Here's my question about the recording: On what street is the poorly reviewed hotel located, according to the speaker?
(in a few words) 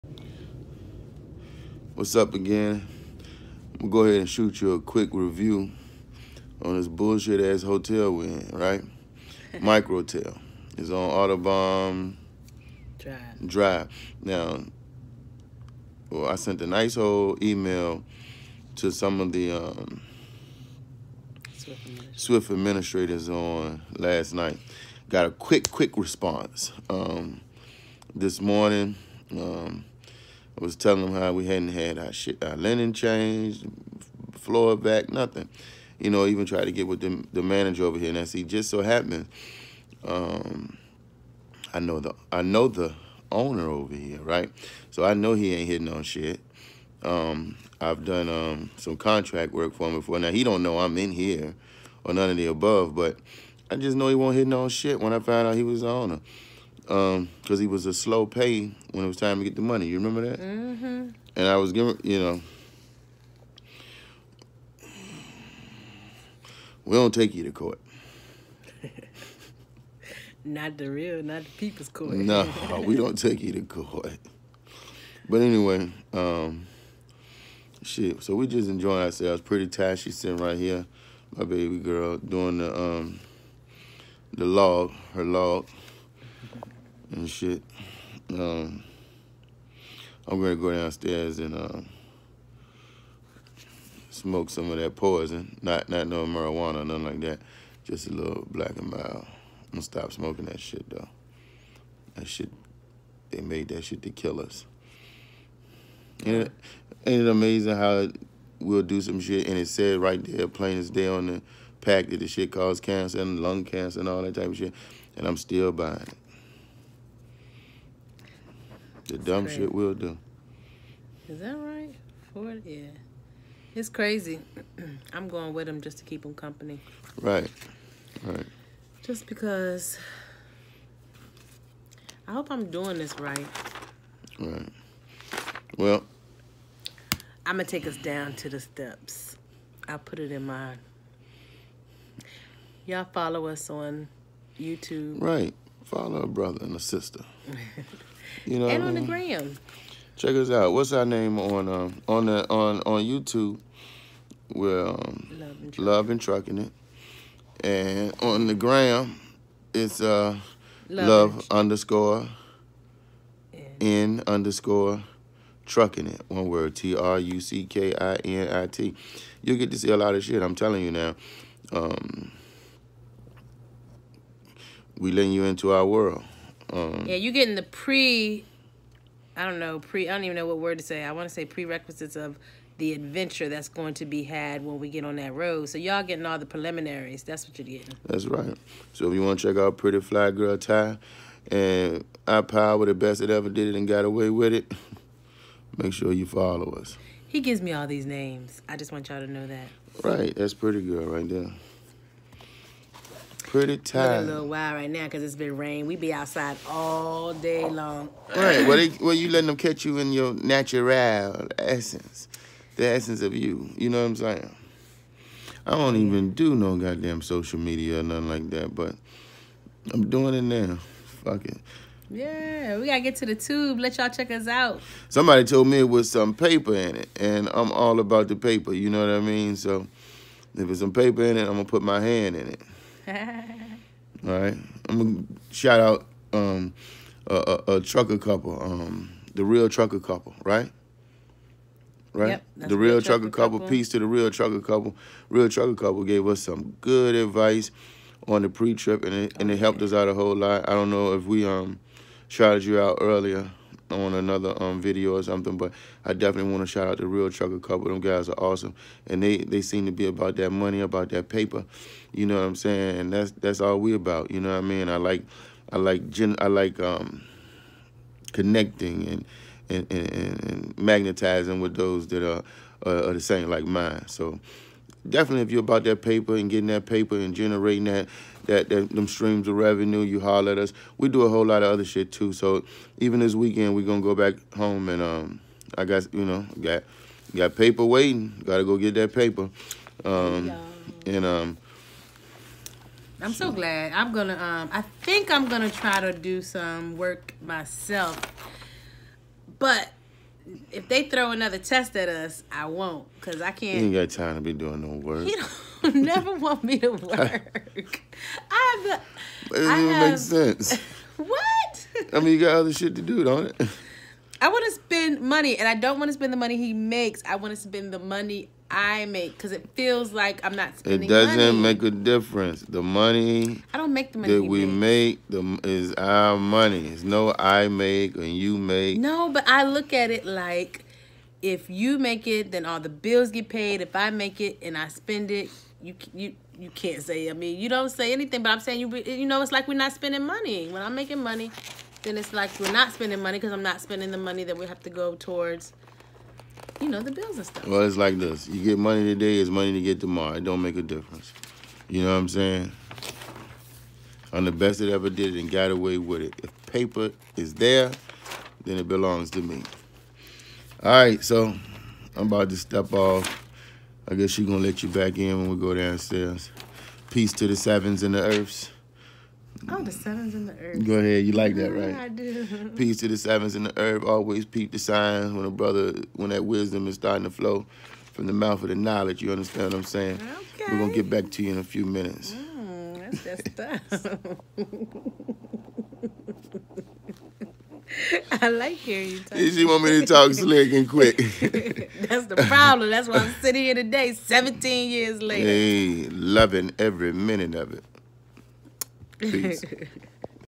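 Autobahn Drive.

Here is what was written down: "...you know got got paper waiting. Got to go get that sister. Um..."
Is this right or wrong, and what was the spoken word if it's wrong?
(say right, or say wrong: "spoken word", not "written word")
wrong: "paper", not "sister".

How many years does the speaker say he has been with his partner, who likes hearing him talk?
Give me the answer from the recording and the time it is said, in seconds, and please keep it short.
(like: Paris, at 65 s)
17, at 394 s.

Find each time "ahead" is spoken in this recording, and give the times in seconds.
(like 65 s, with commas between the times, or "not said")
4 s, 370 s.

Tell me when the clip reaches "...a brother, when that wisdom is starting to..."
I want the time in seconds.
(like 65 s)
375 s.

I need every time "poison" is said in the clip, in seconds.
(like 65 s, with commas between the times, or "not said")
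94 s.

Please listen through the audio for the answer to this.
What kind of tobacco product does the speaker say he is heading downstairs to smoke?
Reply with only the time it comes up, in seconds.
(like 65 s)
98 s.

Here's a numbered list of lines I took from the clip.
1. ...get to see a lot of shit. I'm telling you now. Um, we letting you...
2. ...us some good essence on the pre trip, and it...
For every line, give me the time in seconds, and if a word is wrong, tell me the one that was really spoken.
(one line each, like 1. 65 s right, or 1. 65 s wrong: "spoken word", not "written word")
1. 169 s right
2. 246 s wrong: "advice", not "essence".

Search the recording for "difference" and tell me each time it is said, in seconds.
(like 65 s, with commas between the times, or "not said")
321 s, 350 s.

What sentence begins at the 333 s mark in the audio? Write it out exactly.
If I make it and I spend it, you you you can't say.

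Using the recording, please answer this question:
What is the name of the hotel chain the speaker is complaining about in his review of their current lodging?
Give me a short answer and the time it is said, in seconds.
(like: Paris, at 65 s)
Microtel, at 9 s.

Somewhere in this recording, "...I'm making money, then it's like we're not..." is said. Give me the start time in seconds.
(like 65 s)
340 s.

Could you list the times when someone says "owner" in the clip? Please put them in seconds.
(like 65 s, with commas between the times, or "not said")
43 s, 55 s.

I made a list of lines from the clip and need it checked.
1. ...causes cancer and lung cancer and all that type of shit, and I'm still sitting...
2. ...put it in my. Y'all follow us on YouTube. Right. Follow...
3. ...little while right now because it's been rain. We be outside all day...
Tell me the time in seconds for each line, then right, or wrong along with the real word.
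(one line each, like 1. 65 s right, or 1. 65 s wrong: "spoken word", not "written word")
1. 112 s wrong: "buying", not "sitting"
2. 139 s right
3. 204 s right.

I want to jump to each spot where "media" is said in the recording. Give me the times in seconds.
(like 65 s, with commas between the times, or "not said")
217 s.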